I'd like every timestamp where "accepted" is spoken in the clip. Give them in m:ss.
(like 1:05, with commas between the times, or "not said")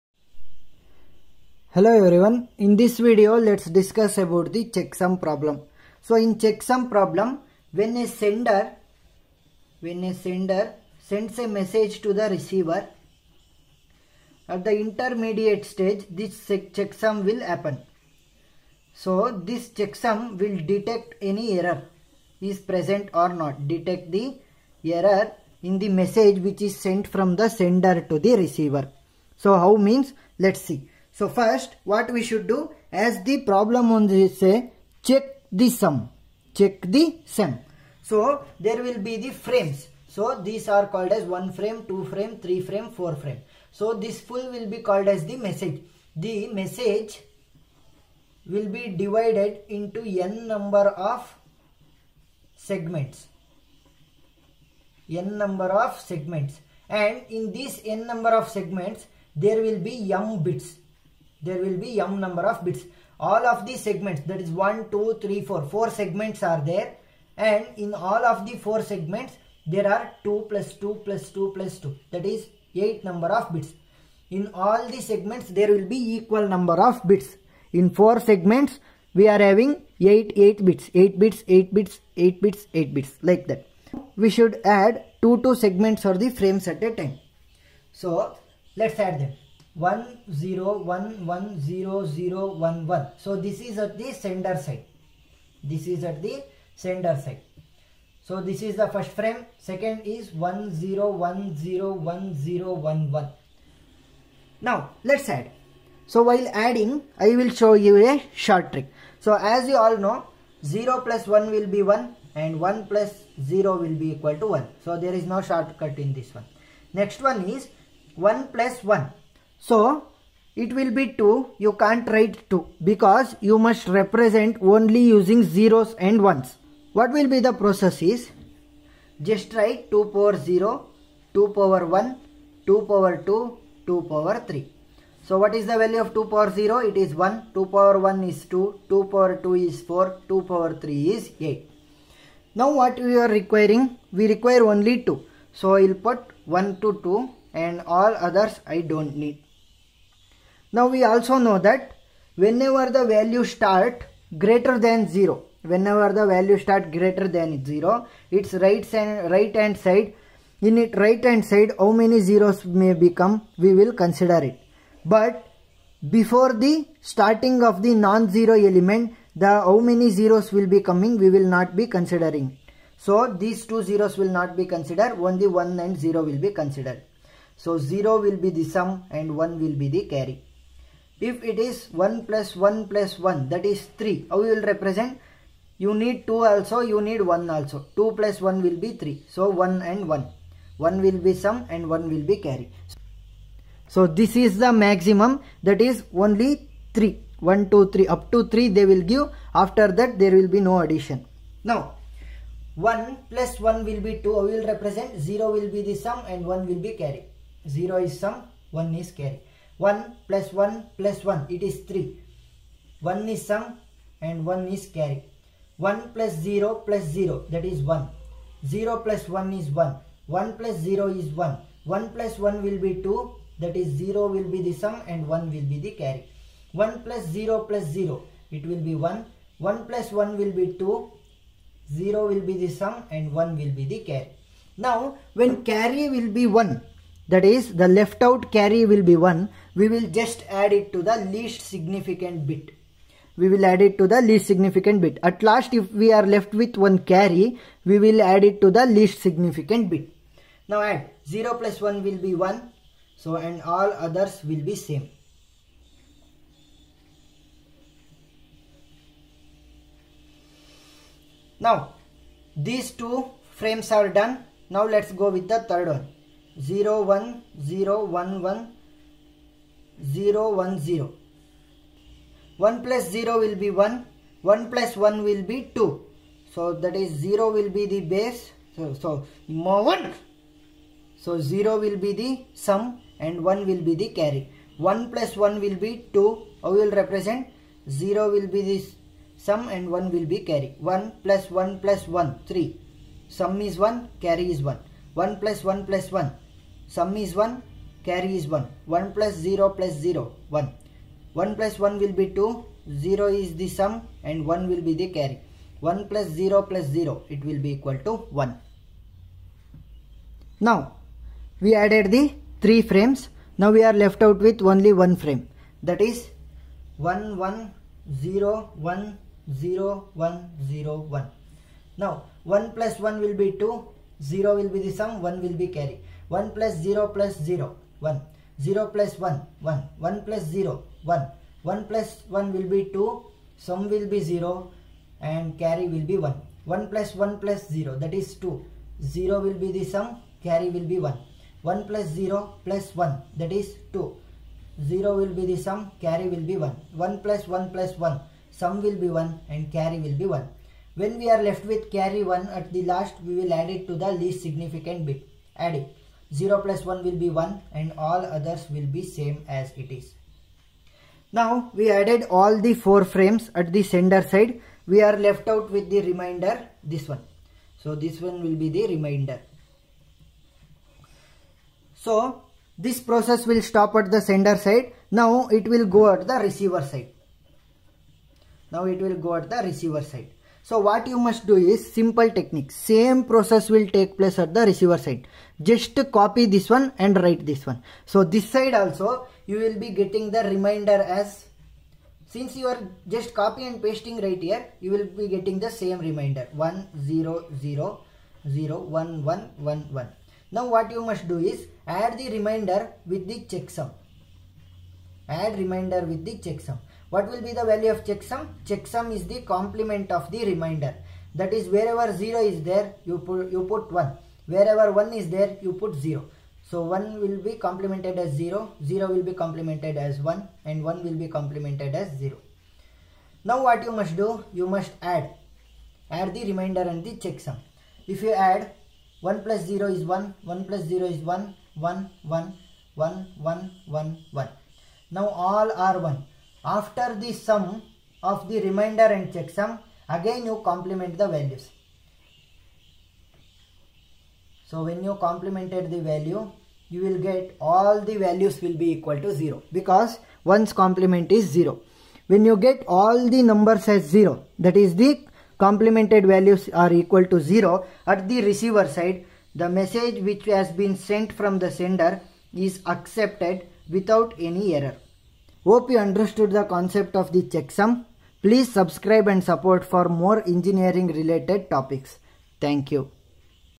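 7:42.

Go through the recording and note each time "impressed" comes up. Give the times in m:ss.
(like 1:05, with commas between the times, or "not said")
not said.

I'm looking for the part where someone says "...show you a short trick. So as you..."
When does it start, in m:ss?
1:47.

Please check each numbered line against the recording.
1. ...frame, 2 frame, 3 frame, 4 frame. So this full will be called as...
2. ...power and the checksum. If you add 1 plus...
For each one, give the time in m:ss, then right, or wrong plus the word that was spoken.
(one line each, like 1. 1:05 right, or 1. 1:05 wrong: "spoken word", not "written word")
1. 0:41 right
2. 7:06 wrong: "remainder", not "power".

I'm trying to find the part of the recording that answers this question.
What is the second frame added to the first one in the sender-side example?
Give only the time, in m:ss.
1:40.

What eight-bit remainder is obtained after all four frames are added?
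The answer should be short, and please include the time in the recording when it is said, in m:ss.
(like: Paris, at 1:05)
10001111, at 6:36.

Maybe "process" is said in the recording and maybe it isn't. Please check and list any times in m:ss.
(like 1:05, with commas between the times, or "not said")
2:07, 6:12, 6:23.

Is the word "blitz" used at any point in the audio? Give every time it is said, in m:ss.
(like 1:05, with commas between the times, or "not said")
not said.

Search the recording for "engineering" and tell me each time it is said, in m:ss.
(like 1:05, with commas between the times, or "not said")
7:50.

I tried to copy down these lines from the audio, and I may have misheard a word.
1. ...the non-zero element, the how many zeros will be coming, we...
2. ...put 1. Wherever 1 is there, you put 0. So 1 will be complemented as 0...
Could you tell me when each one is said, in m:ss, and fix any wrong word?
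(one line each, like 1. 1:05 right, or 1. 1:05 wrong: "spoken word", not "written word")
1. 2:47 right
2. 6:53 right.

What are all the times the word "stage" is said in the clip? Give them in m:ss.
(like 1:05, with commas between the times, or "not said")
0:15.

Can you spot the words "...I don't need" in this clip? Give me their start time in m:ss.
2:28.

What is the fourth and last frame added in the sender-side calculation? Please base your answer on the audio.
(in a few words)
11010101.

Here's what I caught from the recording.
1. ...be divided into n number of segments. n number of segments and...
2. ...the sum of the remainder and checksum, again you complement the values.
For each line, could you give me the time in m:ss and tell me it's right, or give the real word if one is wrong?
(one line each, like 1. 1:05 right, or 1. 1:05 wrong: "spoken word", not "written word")
1. 0:48 right
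2. 7:17 right.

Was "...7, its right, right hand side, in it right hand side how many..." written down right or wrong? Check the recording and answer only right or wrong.
wrong.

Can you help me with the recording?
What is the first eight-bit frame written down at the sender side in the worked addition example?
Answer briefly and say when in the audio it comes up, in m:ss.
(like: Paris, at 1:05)
10110011, at 1:29.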